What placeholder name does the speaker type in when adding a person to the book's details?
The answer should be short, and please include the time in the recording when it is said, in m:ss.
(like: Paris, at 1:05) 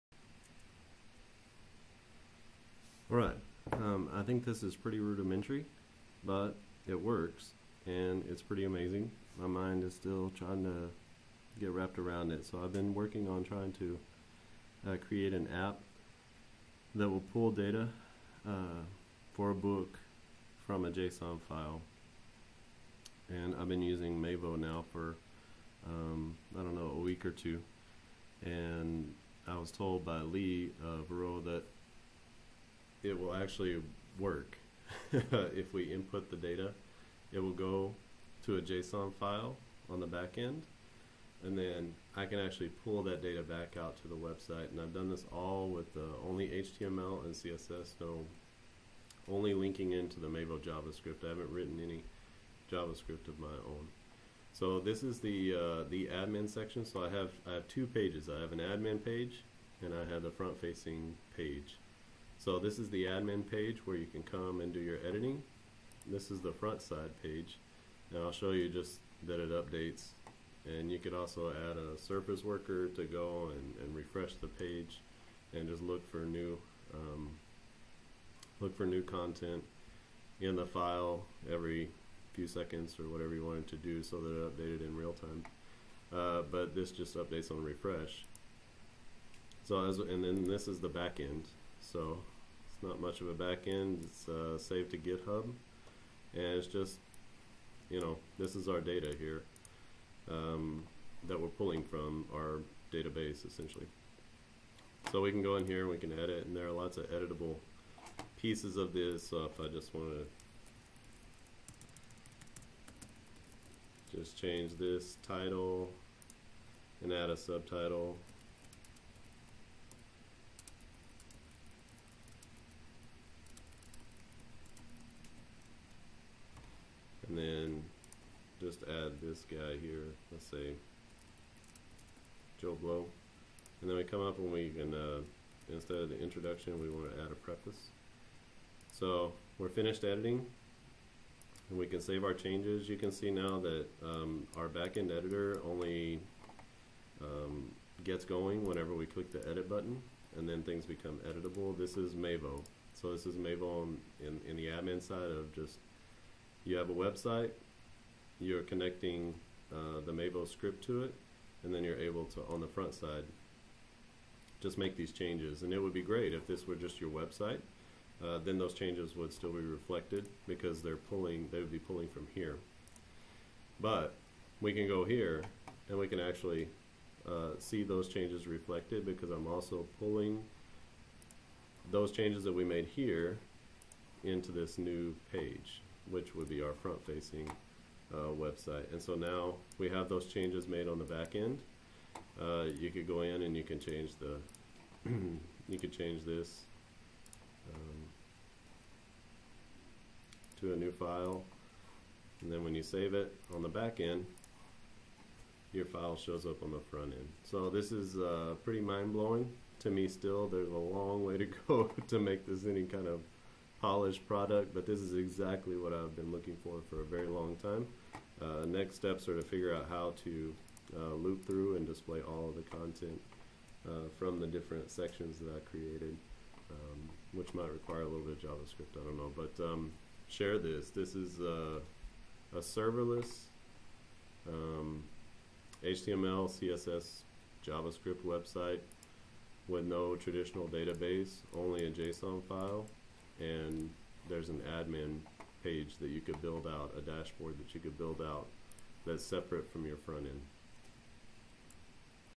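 Joe Blow, at 2:12.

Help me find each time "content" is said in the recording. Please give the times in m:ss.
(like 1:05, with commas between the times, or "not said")
1:19, 3:42.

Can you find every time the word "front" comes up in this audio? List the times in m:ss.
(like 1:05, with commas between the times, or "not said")
1:00, 1:06, 2:42, 3:06, 3:26, 4:09.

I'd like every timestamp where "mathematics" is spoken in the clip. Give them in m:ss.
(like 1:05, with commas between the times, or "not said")
not said.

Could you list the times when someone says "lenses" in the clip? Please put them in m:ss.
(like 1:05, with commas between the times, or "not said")
not said.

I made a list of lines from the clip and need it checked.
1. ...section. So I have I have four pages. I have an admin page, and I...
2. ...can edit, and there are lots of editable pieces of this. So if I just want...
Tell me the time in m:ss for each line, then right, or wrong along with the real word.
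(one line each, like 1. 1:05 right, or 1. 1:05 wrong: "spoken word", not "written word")
1. 0:56 wrong: "two", not "four"
2. 1:45 right.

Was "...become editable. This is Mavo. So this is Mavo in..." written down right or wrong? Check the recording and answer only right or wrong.
right.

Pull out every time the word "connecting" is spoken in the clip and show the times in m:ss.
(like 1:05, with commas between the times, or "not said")
2:38.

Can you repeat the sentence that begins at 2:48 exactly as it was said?
Uh, then those changes would still be reflected because they're pulling, they would be pulling from here.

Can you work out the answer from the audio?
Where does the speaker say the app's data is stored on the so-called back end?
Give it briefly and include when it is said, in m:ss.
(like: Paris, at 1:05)
GitHub, at 1:34.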